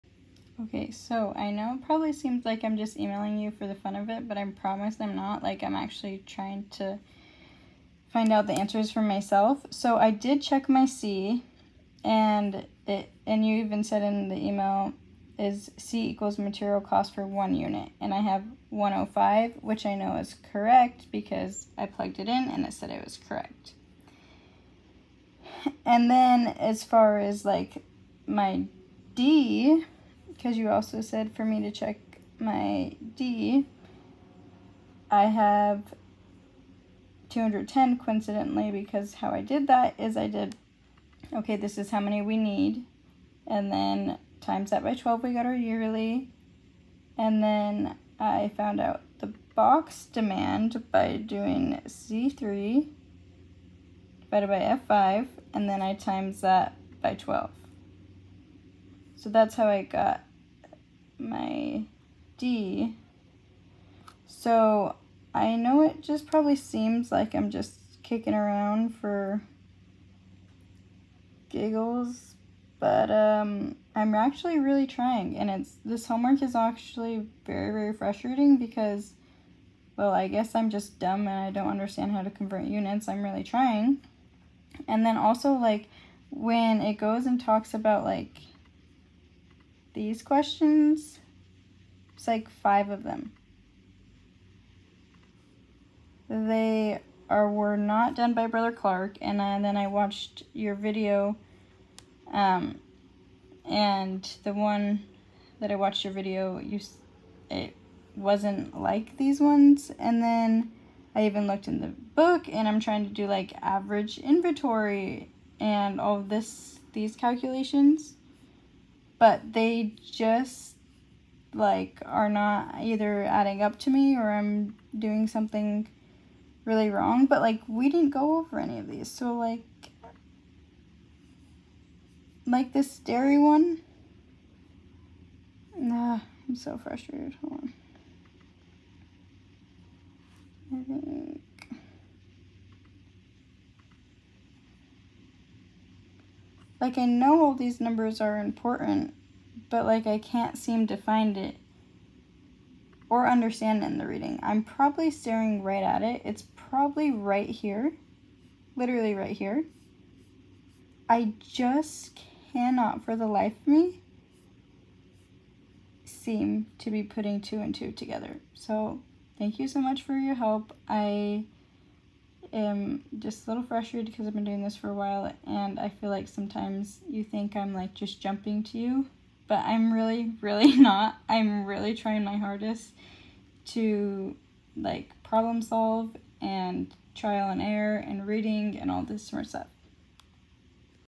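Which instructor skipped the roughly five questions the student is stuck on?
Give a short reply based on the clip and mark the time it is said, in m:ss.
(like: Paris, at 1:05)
Brother Clark, at 1:38.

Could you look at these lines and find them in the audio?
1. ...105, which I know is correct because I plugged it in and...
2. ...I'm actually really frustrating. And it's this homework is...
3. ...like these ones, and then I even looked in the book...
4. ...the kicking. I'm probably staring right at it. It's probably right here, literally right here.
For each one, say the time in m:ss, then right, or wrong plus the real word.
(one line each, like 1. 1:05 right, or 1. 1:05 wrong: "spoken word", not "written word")
1. 0:18 right
2. 1:13 wrong: "trying", not "frustrating"
3. 1:48 right
4. 2:33 wrong: "reading", not "kicking".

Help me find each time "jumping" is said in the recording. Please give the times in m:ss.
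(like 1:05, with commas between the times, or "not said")
2:58.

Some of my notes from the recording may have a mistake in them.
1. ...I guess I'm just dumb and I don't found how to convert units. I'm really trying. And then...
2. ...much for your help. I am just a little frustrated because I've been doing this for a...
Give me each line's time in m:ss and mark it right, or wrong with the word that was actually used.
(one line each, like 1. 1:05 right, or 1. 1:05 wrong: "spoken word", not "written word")
1. 1:20 wrong: "understand", not "found"
2. 2:49 right.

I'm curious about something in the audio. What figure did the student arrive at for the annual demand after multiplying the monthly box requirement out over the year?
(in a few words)
210.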